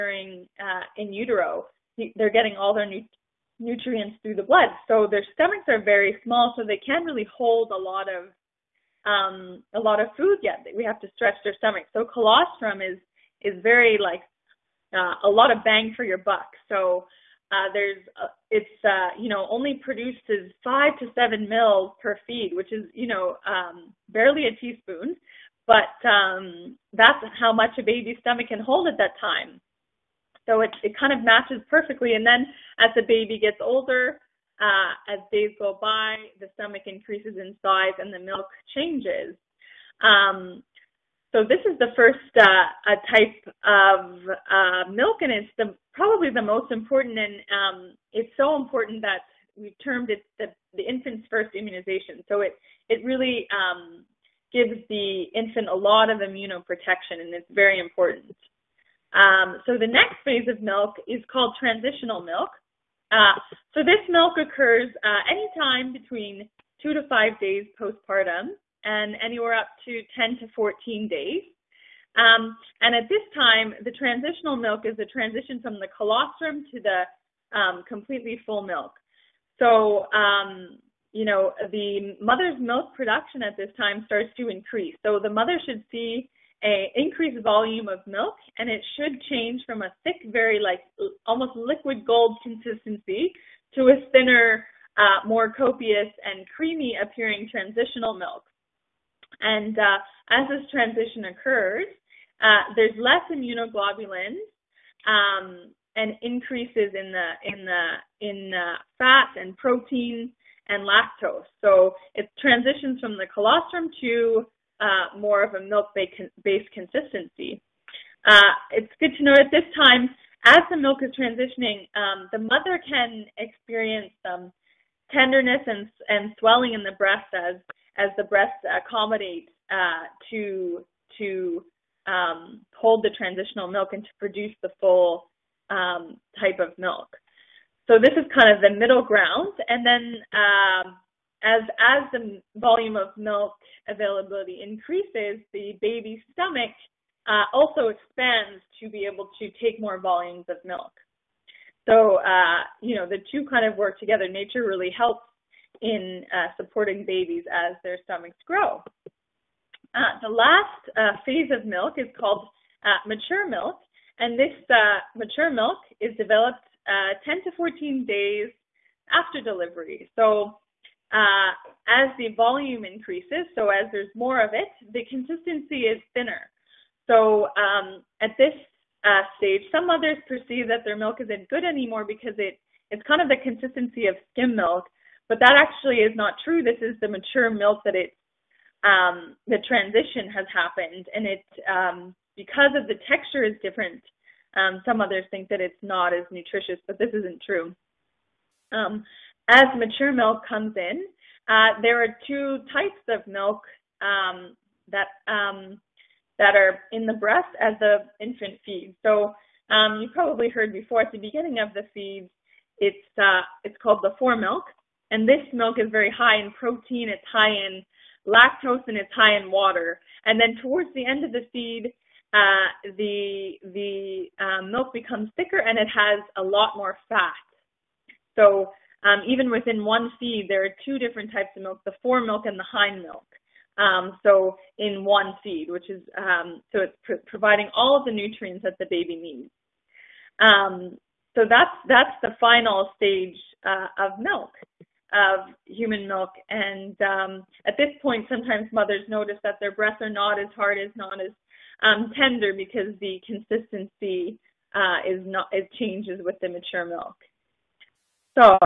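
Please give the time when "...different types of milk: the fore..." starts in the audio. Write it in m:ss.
3:50.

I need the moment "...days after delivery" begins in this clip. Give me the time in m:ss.
2:48.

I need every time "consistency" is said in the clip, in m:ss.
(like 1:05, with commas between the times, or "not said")
1:32, 1:56, 2:55, 3:03, 4:13.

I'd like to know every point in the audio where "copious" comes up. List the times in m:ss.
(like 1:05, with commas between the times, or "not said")
1:35.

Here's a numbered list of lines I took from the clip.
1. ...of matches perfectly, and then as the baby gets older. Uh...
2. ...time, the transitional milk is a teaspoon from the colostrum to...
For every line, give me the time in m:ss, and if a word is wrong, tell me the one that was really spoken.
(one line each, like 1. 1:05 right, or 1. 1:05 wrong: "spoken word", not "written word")
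1. 0:31 right
2. 1:13 wrong: "transition", not "teaspoon".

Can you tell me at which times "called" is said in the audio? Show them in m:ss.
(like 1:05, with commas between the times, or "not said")
1:01, 2:42, 3:33.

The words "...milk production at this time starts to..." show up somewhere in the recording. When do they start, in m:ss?
1:22.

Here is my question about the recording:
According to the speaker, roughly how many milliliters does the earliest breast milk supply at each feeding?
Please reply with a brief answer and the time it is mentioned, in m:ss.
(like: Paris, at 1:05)
5 to 7, at 0:20.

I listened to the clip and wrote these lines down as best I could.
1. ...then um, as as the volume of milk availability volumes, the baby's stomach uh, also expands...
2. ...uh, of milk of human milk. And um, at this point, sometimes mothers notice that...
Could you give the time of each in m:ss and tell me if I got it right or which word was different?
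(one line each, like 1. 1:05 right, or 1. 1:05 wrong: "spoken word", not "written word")
1. 2:19 wrong: "increases", not "volumes"
2. 4:03 right.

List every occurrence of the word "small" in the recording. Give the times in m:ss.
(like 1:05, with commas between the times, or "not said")
0:06.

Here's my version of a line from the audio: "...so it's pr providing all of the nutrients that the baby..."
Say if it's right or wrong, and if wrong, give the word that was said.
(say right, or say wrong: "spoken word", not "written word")
right.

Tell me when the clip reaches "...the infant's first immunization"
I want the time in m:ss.
0:50.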